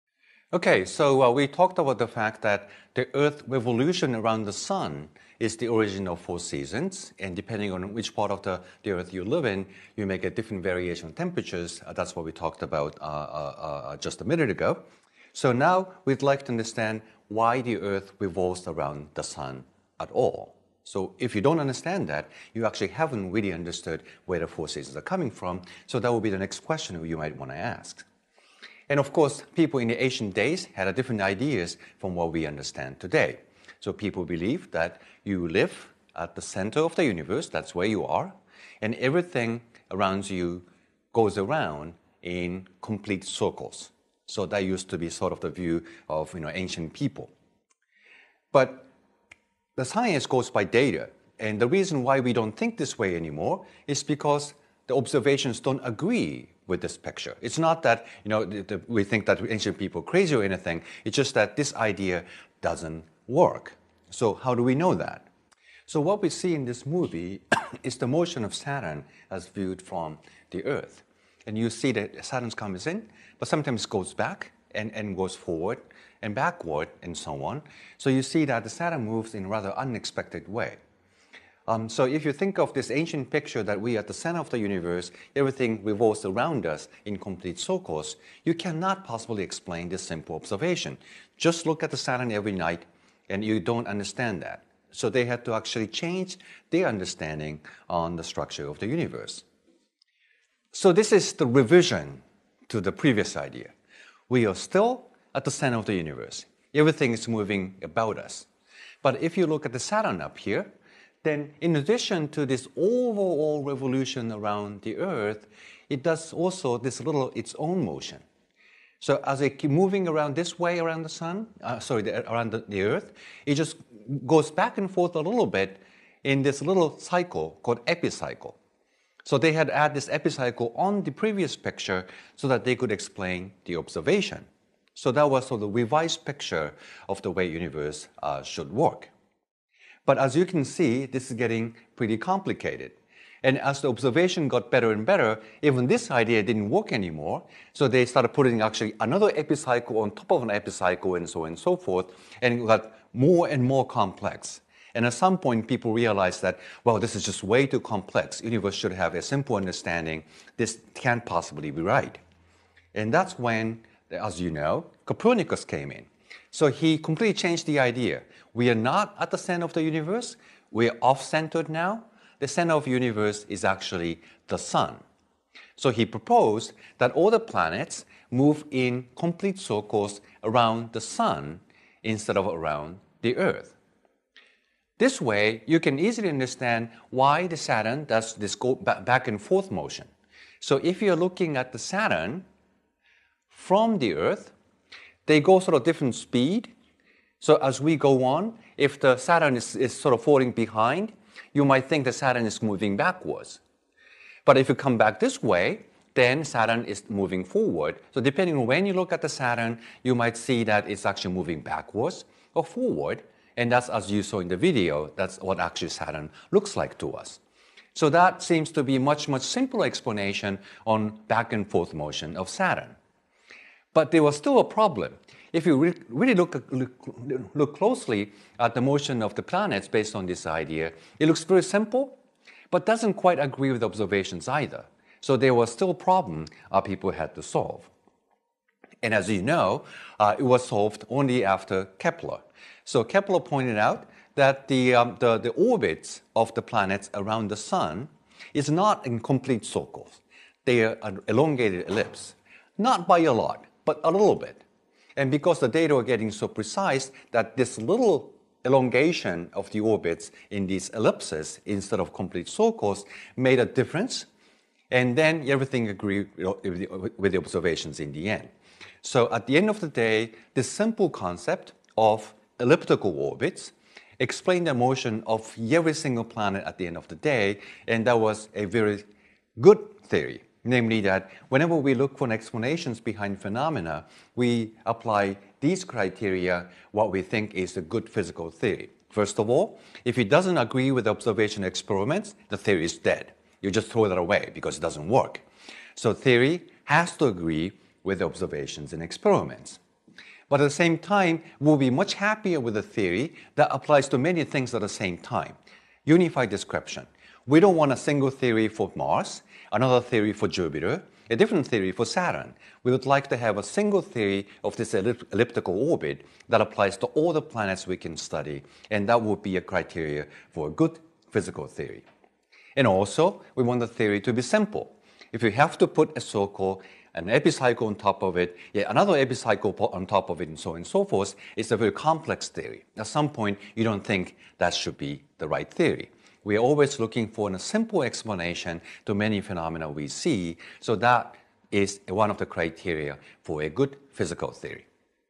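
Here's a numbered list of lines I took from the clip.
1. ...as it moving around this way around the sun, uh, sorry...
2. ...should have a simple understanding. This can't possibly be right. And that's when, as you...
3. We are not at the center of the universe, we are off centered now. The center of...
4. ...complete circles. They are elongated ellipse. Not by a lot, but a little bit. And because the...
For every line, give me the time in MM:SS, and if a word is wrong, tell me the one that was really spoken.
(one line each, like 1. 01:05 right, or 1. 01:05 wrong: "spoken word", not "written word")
1. 01:59 right
2. 02:38 right
3. 02:48 right
4. 04:09 right.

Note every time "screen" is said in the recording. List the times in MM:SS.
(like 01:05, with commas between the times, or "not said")
not said.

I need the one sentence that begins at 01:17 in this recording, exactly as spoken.
So you see that the Saturn moves in a rather unexpected way.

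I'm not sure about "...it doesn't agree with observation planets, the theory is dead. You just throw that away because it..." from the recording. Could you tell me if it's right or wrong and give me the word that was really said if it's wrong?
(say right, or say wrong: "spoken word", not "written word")
wrong: "experiments", not "planets".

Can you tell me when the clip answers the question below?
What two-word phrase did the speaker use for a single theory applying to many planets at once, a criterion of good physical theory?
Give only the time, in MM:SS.
05:06.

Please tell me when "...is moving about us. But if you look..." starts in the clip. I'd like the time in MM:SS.
01:47.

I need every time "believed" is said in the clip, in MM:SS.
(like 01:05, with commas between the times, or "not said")
00:34.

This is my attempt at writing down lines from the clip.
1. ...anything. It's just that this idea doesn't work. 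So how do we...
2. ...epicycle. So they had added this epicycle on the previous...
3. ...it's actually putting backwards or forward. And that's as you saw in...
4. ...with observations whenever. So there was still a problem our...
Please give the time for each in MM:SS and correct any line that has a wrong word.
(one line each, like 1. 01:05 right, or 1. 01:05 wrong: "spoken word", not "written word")
1. 01:00 right
2. 02:07 right
3. 03:30 wrong: "moving", not "putting"
4. 03:53 wrong: "either", not "whenever".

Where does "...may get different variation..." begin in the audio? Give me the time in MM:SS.
00:10.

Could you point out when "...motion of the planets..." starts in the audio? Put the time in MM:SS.
03:48.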